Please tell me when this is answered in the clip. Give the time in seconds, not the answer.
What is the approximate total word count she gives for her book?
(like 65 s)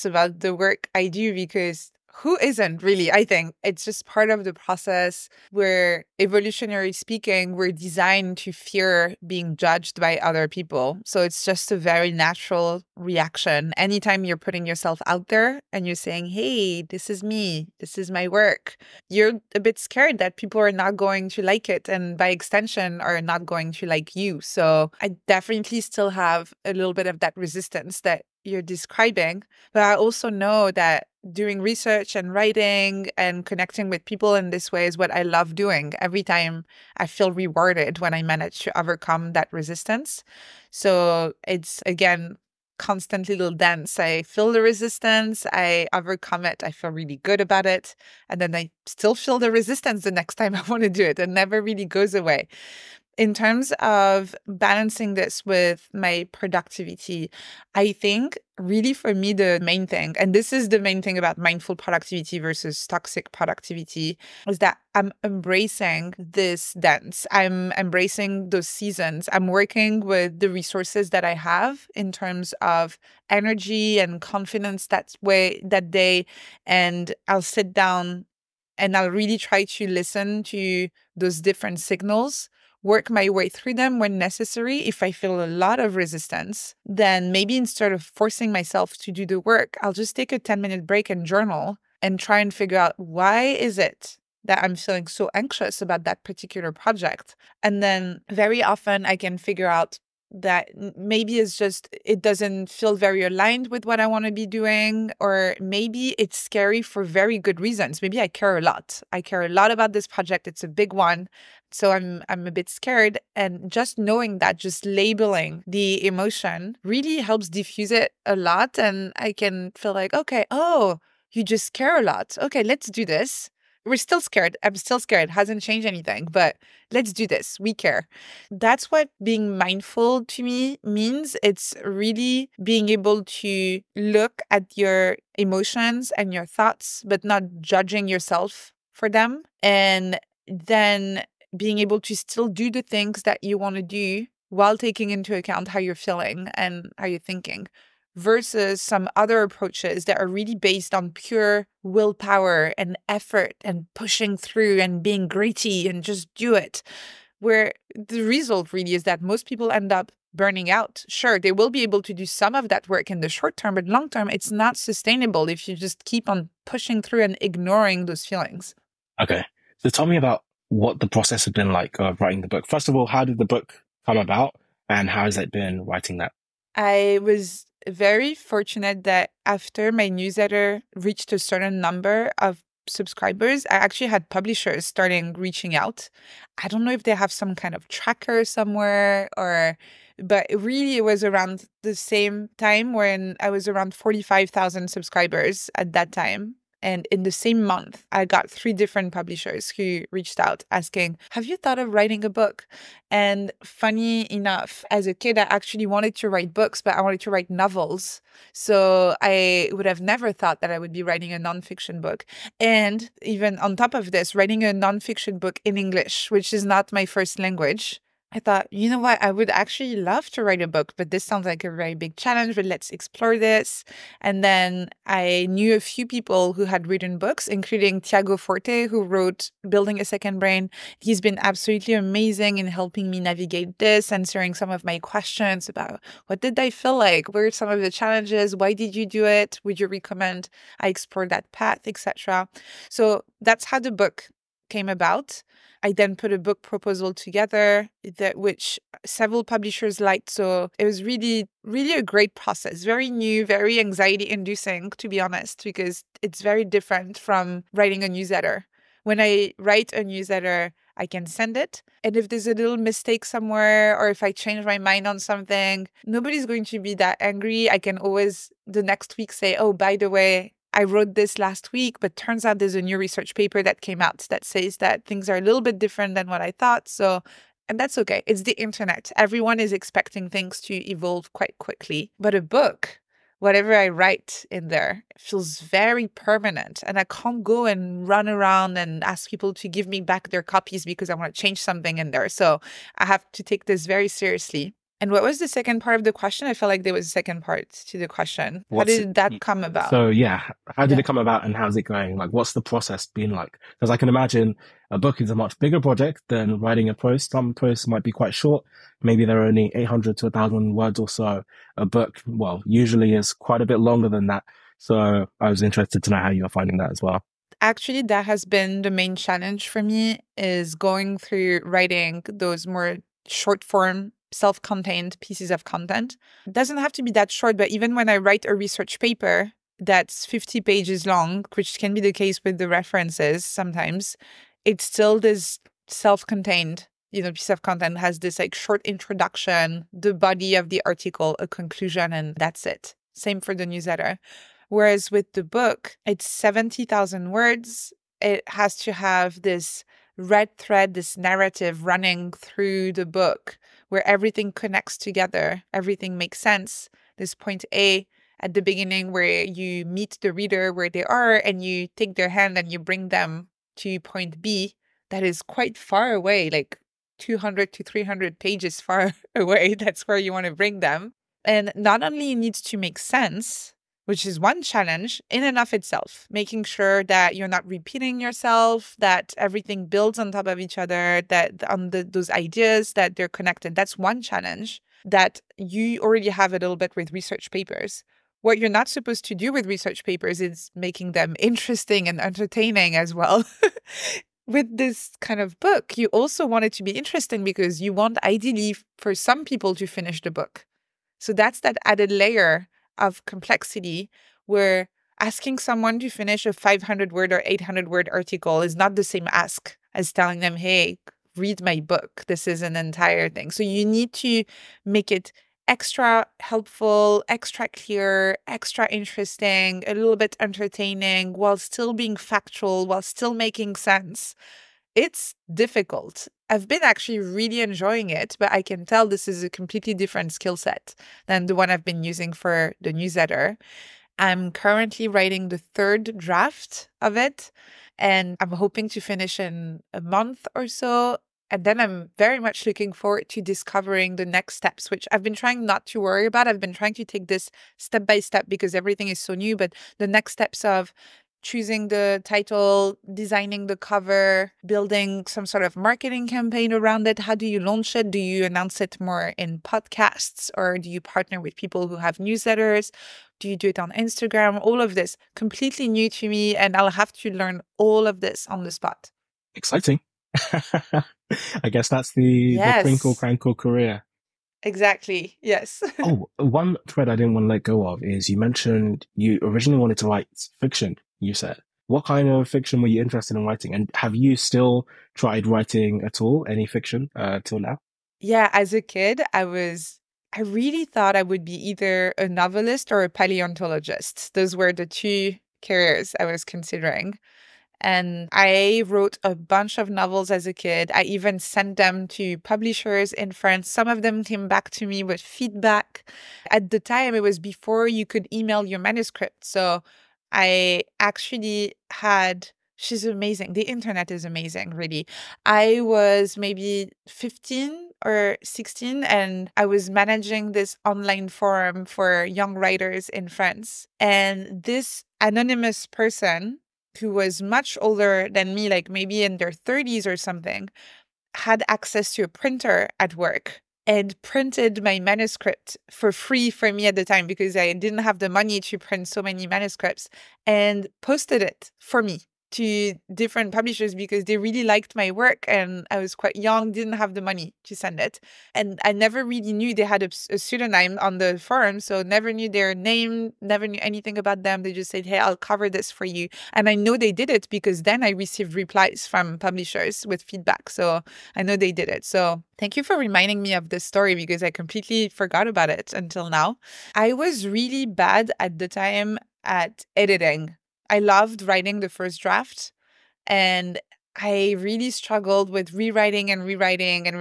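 346 s.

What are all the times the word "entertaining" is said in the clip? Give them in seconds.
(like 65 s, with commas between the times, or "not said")
392 s, 420 s.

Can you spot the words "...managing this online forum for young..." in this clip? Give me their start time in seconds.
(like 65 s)
519 s.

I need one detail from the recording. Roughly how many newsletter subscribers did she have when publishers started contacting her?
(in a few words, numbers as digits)
45,000.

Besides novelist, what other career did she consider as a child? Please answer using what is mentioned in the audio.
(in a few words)
Paleontologist.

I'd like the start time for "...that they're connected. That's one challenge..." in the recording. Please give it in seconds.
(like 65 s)
382 s.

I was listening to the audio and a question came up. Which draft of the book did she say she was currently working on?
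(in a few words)
Third.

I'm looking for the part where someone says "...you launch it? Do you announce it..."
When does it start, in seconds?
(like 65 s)
457 s.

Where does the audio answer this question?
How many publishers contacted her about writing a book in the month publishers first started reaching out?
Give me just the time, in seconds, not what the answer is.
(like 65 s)
198 s.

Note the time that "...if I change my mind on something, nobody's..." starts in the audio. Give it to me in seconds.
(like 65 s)
264 s.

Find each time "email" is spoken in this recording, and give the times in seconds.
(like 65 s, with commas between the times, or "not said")
508 s.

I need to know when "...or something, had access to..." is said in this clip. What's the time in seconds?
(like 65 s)
530 s.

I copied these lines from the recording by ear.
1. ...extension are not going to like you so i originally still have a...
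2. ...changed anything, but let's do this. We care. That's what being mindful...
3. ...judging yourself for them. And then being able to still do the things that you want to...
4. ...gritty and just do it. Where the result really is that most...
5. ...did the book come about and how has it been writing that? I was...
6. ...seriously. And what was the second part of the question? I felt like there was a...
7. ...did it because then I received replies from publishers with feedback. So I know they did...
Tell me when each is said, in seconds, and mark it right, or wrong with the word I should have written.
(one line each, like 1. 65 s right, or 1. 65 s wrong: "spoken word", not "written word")
1. 22 s wrong: "definitely", not "originally"
2. 125 s right
3. 137 s right
4. 155 s right
5. 173 s right
6. 294 s right
7. 557 s right.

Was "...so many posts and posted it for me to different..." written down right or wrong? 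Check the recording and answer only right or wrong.
wrong.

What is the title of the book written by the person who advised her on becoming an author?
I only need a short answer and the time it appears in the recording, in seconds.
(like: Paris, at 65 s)
Building a Second Brain, at 229 s.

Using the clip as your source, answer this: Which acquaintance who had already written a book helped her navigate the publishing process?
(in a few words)
Tiago Forte.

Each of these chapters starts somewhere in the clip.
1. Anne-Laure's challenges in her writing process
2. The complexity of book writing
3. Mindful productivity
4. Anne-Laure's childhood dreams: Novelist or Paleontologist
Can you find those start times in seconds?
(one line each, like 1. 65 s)
1. 175 s
2. 316 s
3. 52 s
4. 487 s.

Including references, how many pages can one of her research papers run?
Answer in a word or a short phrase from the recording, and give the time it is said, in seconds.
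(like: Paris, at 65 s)
50, at 330 s.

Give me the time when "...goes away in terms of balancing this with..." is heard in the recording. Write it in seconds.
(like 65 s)
51 s.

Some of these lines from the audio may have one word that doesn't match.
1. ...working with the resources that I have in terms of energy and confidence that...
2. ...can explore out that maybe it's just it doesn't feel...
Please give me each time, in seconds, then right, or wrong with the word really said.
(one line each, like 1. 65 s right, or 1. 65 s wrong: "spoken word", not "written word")
1. 69 s right
2. 99 s wrong: "figure", not "explore".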